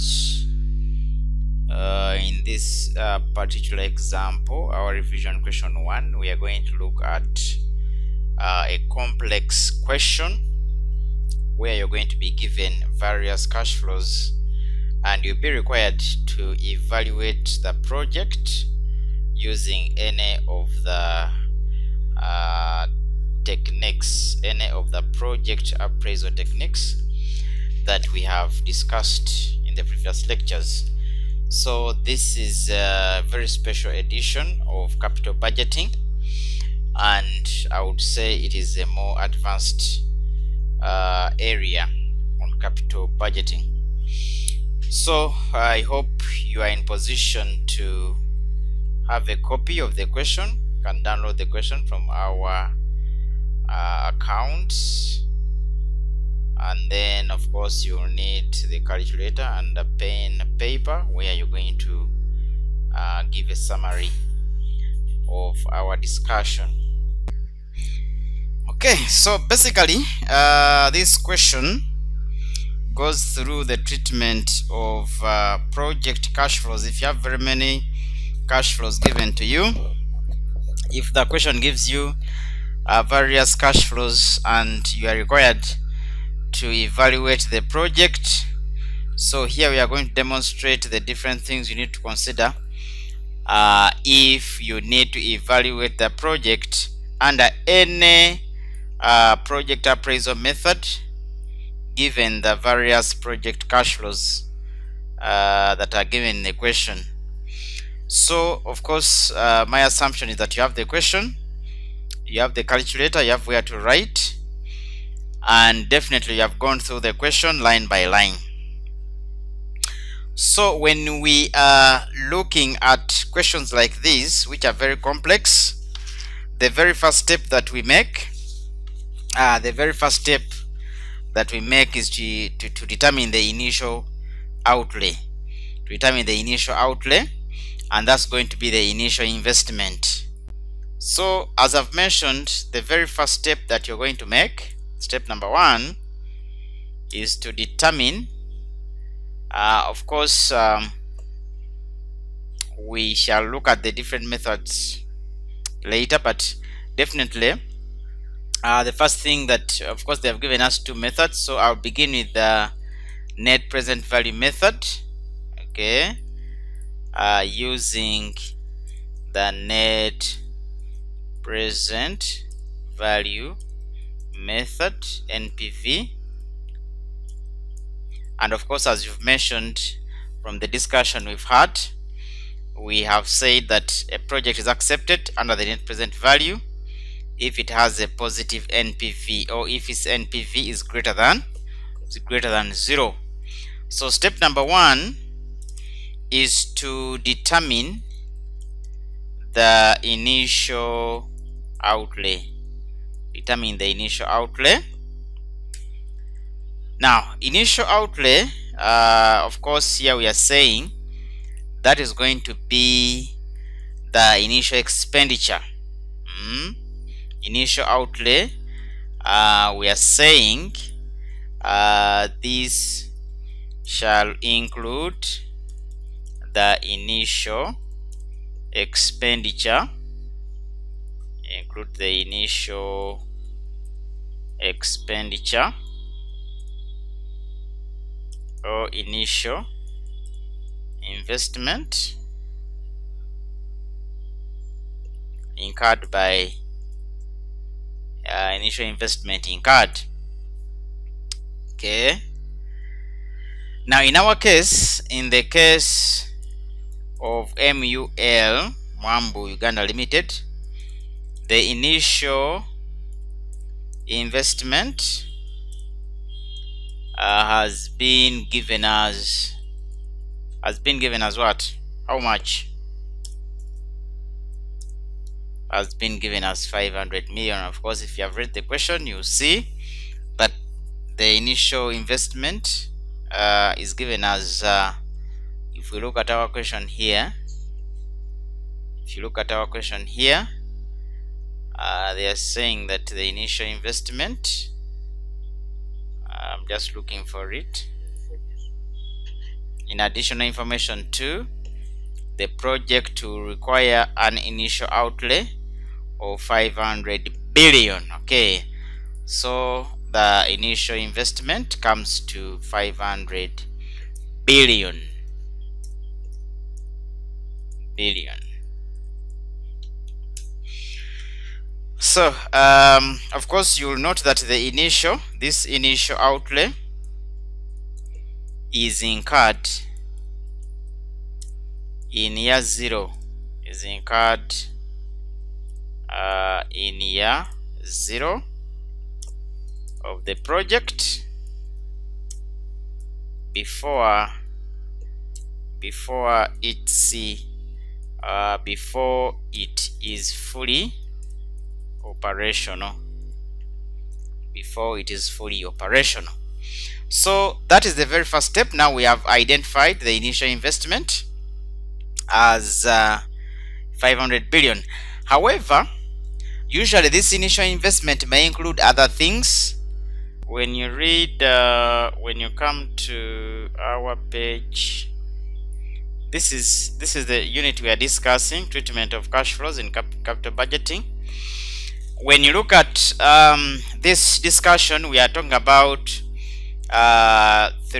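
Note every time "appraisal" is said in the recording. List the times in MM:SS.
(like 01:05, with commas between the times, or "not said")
00:25, 01:39.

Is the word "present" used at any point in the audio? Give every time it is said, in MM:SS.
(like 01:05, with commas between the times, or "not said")
02:43, 02:51, 03:05.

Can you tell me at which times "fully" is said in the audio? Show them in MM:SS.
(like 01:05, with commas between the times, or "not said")
05:50, 05:55.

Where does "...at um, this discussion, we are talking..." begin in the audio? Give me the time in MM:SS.
06:22.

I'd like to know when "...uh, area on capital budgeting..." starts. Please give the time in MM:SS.
00:40.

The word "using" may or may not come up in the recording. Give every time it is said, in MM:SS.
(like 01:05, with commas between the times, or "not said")
00:19, 02:47.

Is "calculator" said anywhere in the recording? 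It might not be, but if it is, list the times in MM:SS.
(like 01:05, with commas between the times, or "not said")
00:58, 01:52.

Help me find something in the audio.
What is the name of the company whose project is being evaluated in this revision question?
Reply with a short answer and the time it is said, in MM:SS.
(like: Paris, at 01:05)
Mul Mwambu Uganda Limited, at 04:17.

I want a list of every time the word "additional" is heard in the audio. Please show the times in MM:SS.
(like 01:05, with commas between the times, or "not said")
04:59.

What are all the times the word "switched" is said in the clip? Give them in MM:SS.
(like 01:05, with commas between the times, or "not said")
not said.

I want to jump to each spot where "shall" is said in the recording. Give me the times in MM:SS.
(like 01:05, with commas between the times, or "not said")
02:33, 03:43.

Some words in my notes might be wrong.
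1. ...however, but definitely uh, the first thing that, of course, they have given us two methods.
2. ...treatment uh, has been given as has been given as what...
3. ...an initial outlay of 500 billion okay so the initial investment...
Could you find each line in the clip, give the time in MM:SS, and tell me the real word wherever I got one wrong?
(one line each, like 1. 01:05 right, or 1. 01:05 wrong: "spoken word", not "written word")
1. 02:35 wrong: "later", not "however"
2. 04:24 wrong: "investment", not "treatment"
3. 05:04 right.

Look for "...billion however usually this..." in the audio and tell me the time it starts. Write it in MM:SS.
06:04.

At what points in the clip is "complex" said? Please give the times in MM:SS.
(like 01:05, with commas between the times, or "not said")
00:08, 02:04.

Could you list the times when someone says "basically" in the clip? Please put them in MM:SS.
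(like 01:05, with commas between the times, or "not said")
01:09.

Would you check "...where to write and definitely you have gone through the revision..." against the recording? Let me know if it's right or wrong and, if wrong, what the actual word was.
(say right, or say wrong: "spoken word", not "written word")
wrong: "question", not "revision".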